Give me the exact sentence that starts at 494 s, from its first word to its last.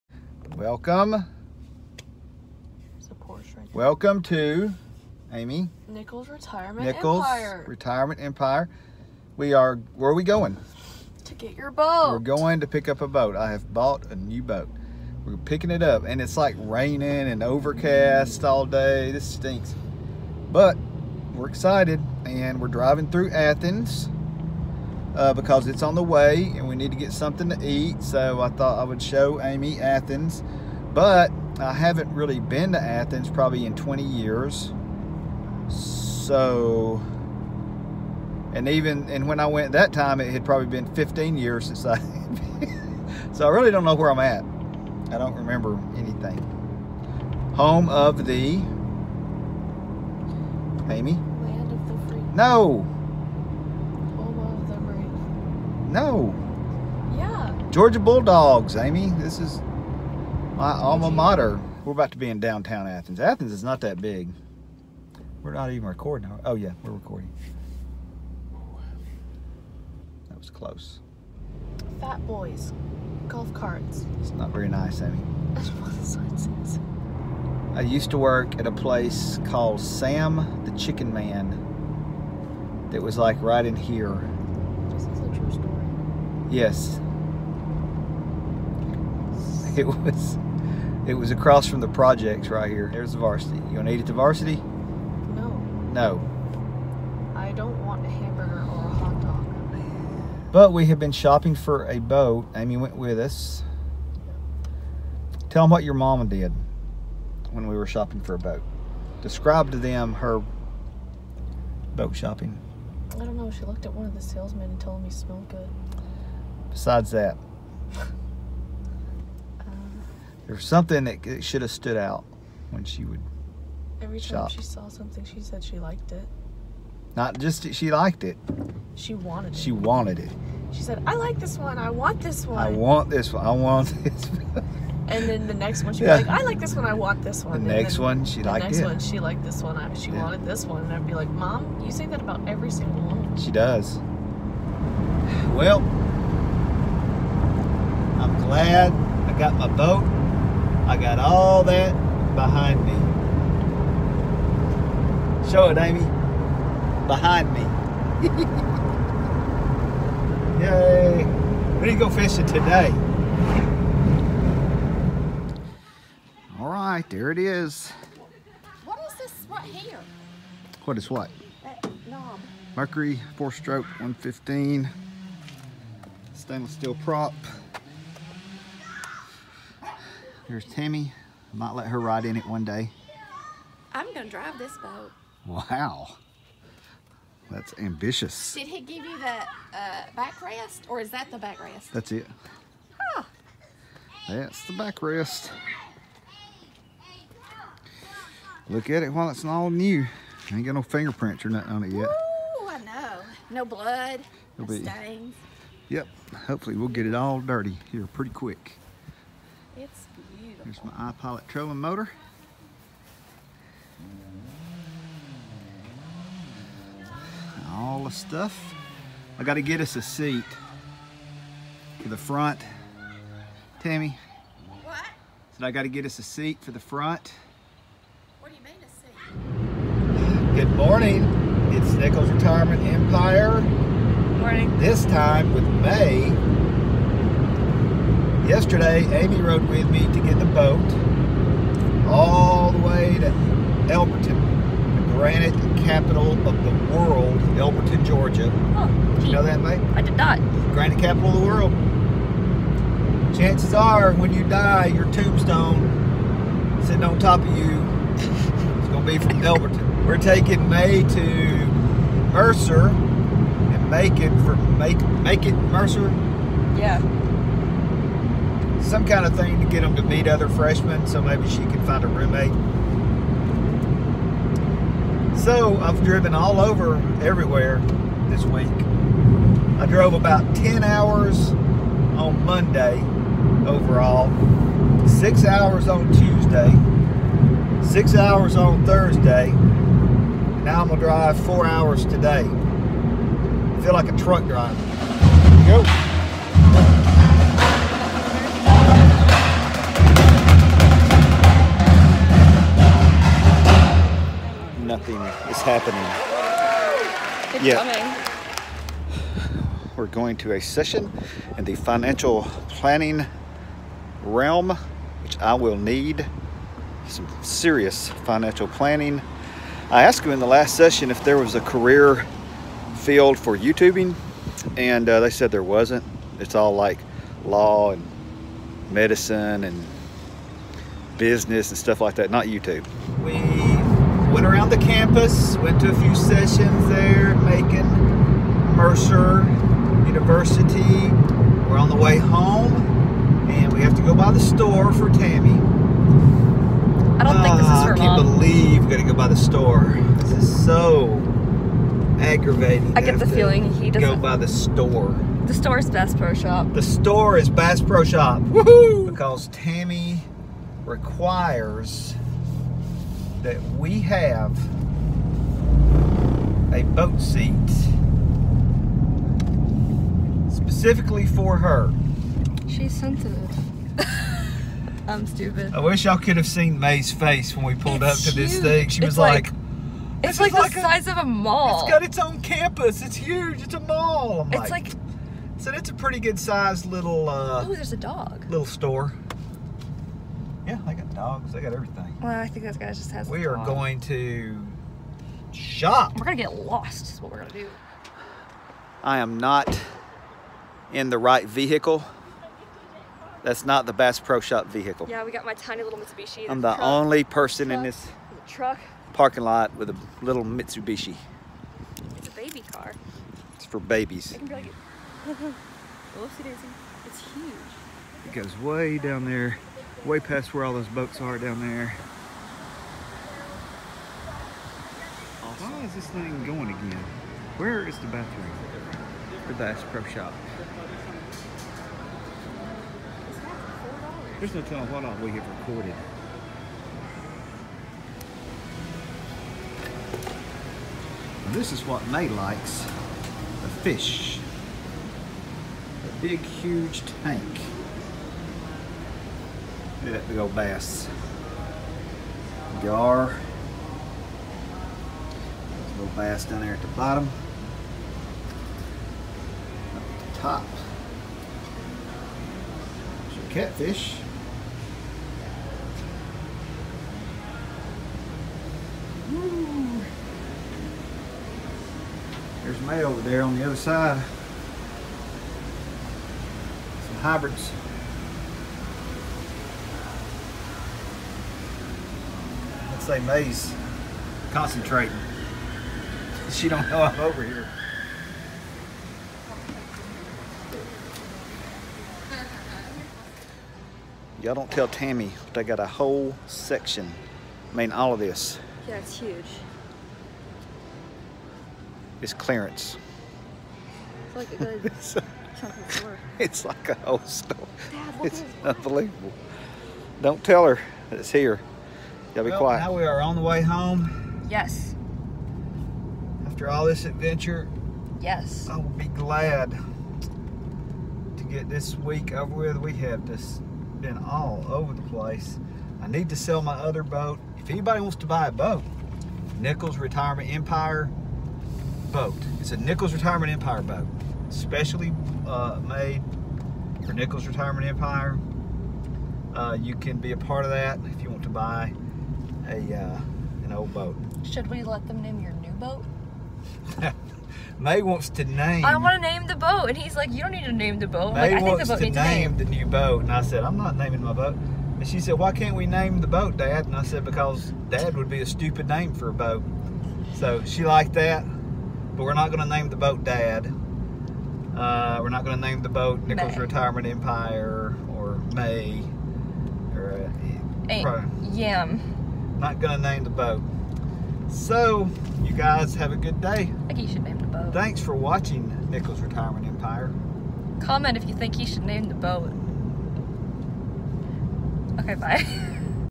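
Y'all don't tell Tammy, but I got a whole section.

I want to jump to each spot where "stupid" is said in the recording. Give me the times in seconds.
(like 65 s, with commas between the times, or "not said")
375 s, 558 s.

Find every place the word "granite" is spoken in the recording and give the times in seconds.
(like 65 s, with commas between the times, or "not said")
245 s, 250 s.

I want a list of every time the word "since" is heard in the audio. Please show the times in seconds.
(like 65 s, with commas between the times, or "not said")
41 s.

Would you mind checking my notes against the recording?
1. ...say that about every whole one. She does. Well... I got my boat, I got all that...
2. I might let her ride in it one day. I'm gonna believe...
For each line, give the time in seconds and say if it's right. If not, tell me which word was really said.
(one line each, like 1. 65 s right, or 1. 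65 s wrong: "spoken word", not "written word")
1. 141 s wrong: "single", not "whole"
2. 181 s wrong: "drive", not "believe".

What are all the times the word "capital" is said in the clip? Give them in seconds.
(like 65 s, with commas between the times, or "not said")
245 s, 250 s.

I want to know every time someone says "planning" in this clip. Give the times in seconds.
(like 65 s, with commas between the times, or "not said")
312 s, 318 s.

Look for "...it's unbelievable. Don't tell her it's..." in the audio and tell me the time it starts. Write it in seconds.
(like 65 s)
508 s.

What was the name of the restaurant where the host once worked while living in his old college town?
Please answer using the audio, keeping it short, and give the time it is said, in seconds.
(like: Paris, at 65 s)
Sam the Chicken Man, at 79 s.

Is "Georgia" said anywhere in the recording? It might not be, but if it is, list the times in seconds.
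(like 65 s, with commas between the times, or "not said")
57 s, 248 s.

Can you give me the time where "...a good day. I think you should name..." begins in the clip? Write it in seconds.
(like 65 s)
576 s.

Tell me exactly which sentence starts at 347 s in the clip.
I don't uh, think this is her ah, I can't mom.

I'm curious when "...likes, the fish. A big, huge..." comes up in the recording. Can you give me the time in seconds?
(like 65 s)
442 s.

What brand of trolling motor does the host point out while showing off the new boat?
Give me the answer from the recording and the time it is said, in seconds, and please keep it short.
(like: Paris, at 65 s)
iPilot, at 210 s.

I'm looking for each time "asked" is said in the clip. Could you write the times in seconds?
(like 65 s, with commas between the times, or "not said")
320 s.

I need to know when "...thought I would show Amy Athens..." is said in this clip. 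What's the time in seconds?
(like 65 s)
28 s.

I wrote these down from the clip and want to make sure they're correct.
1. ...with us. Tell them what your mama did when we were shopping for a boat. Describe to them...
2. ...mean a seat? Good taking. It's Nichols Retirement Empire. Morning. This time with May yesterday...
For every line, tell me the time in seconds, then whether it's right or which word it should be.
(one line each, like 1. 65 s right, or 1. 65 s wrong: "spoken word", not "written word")
1. 102 s right
2. 228 s wrong: "morning", not "taking".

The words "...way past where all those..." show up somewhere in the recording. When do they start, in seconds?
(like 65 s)
420 s.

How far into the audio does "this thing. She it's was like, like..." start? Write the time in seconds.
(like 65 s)
378 s.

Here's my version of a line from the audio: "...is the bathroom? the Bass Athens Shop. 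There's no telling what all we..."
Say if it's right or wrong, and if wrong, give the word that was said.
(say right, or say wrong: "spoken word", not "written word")
wrong: "Pro", not "Athens".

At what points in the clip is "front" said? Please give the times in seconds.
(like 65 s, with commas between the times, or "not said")
222 s, 226 s.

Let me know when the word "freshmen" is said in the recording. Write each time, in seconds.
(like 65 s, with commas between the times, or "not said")
270 s.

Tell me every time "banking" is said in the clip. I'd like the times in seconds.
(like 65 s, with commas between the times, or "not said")
not said.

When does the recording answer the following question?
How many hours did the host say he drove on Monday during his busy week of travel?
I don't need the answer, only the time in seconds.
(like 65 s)
280 s.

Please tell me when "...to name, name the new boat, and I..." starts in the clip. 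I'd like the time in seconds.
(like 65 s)
552 s.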